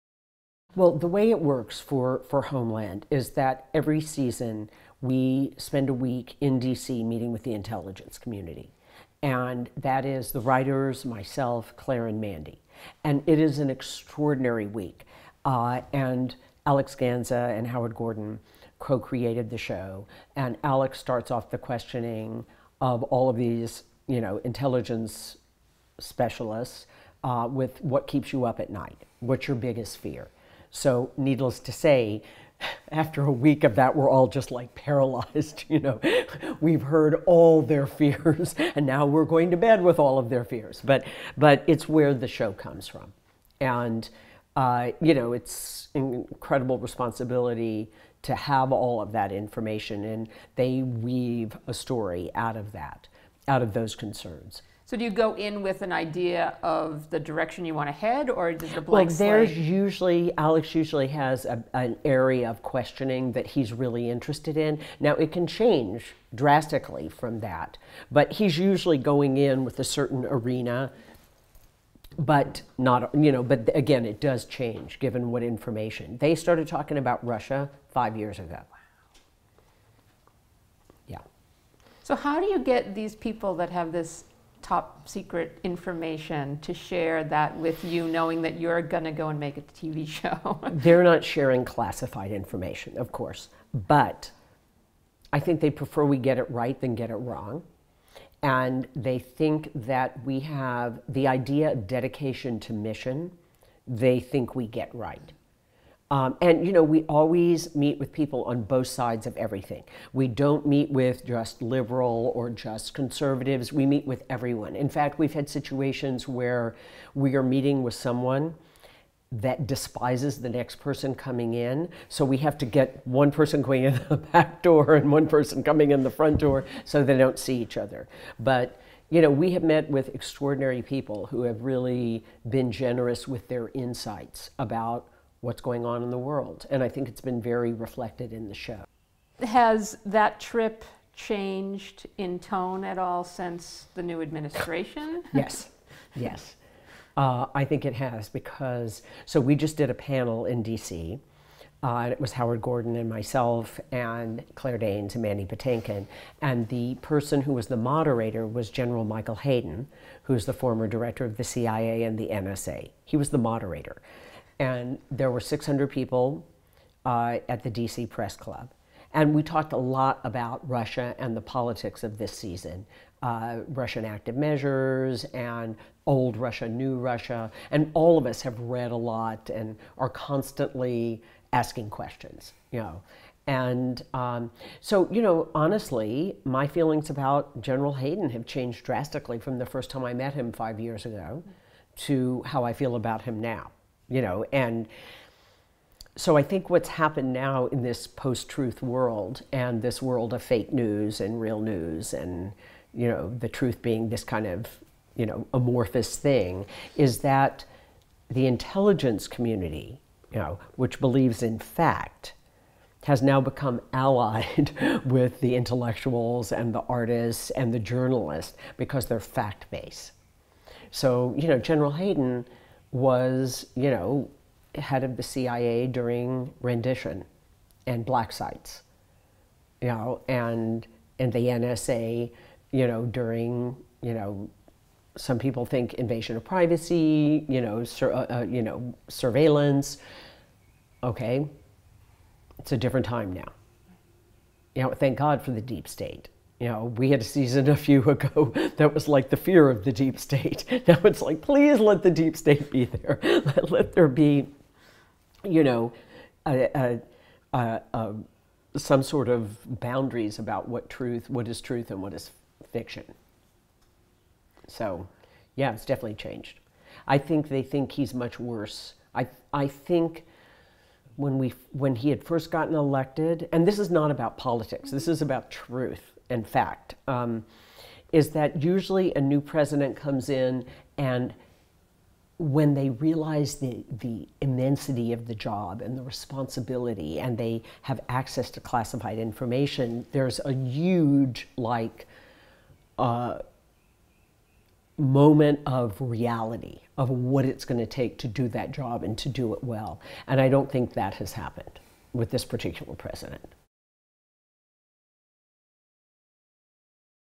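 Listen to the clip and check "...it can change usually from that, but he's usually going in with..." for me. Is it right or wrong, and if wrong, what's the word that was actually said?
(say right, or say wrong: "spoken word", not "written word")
wrong: "drastically", not "usually".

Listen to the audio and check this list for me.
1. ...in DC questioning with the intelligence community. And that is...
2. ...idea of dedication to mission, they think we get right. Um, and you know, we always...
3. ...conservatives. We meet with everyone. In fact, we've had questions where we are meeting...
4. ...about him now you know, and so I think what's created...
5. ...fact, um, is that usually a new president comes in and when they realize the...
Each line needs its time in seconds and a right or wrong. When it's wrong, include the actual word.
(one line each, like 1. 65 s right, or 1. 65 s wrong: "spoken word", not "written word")
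1. 6 s wrong: "meeting", not "questioning"
2. 101 s right
3. 112 s wrong: "situations", not "questions"
4. 192 s wrong: "happened", not "created"
5. 276 s right.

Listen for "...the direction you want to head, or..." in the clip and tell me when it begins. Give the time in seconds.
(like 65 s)
57 s.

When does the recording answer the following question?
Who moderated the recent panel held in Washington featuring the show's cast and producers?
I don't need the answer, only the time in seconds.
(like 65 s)
158 s.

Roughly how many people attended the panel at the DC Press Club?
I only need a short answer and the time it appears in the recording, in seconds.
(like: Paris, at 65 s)
600, at 165 s.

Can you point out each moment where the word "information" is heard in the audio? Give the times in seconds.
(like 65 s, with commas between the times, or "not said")
49 s, 75 s, 85 s, 92 s, 289 s.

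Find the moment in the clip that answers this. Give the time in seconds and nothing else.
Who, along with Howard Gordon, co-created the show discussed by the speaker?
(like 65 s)
16 s.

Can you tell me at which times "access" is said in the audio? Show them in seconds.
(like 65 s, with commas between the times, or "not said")
288 s.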